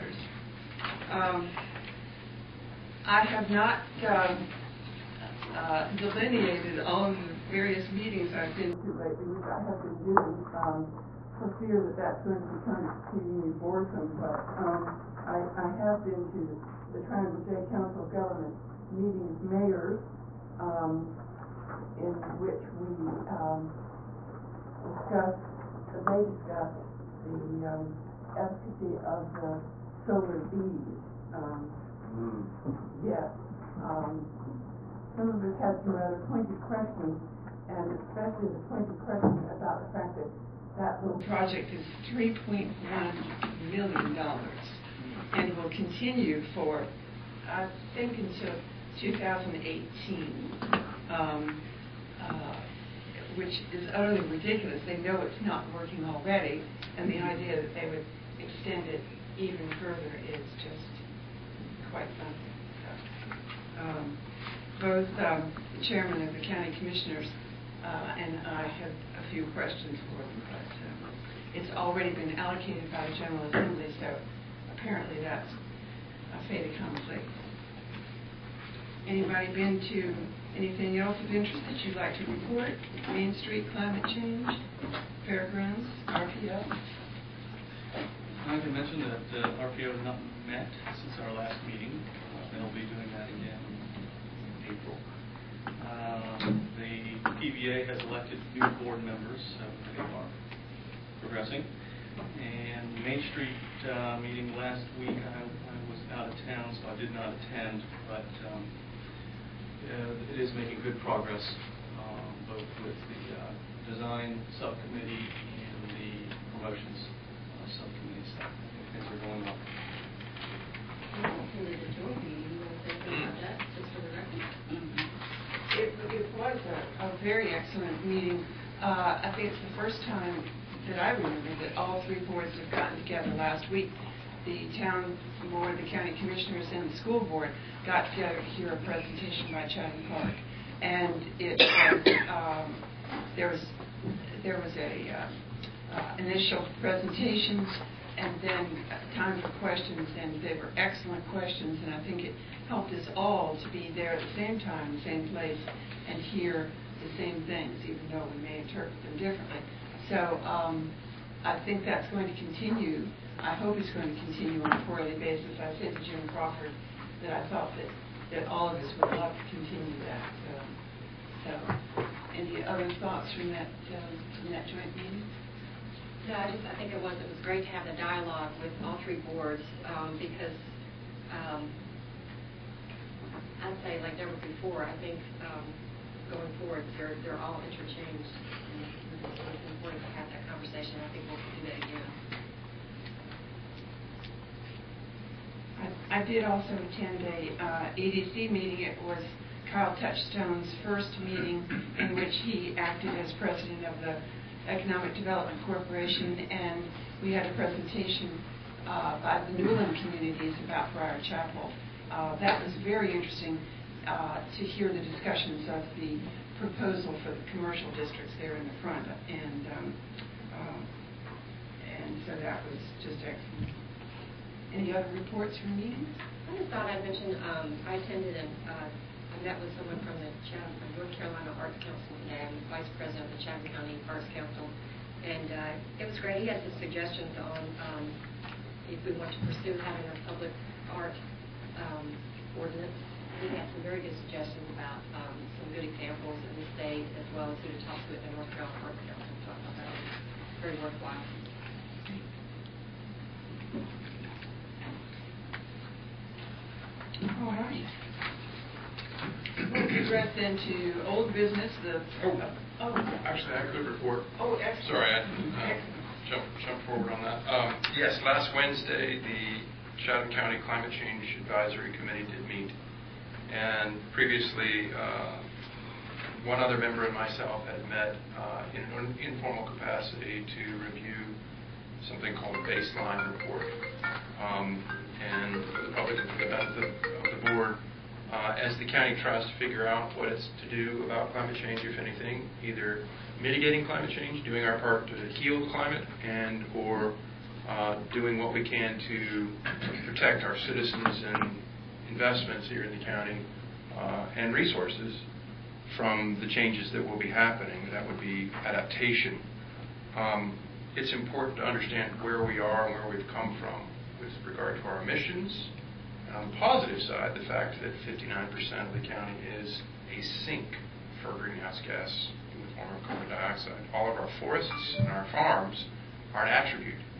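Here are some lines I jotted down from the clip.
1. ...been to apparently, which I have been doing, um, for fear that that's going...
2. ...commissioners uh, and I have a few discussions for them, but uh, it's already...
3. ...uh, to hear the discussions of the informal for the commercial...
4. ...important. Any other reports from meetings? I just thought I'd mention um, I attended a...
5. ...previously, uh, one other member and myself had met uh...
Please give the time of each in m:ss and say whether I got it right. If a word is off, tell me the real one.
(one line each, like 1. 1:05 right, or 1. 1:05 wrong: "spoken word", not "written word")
1. 0:08 wrong: "lately", not "apparently"
2. 1:06 wrong: "questions", not "discussions"
3. 3:34 wrong: "proposal", not "informal"
4. 3:43 wrong: "excellent", not "important"
5. 4:34 right.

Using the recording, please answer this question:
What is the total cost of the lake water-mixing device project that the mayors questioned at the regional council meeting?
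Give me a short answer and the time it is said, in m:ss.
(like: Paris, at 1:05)
$3.1 million, at 0:42.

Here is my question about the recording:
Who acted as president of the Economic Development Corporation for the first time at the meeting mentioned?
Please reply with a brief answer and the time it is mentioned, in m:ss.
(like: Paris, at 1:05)
Kyle Touchstone, at 3:19.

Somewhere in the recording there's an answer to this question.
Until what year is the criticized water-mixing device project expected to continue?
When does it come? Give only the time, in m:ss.
0:48.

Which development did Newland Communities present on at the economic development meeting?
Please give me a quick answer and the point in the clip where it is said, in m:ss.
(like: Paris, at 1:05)
Briar Chapel, at 3:30.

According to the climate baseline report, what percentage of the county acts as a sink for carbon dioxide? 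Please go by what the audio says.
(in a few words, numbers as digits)
59%.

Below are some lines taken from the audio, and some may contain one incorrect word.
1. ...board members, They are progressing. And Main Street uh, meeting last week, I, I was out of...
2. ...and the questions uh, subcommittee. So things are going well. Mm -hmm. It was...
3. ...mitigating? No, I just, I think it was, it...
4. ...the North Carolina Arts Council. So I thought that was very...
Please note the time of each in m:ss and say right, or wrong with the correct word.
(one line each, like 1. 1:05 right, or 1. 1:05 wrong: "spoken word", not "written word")
1. 1:38 right
2. 1:55 wrong: "promotions", not "questions"
3. 2:54 wrong: "meeting", not "mitigating"
4. 4:08 right.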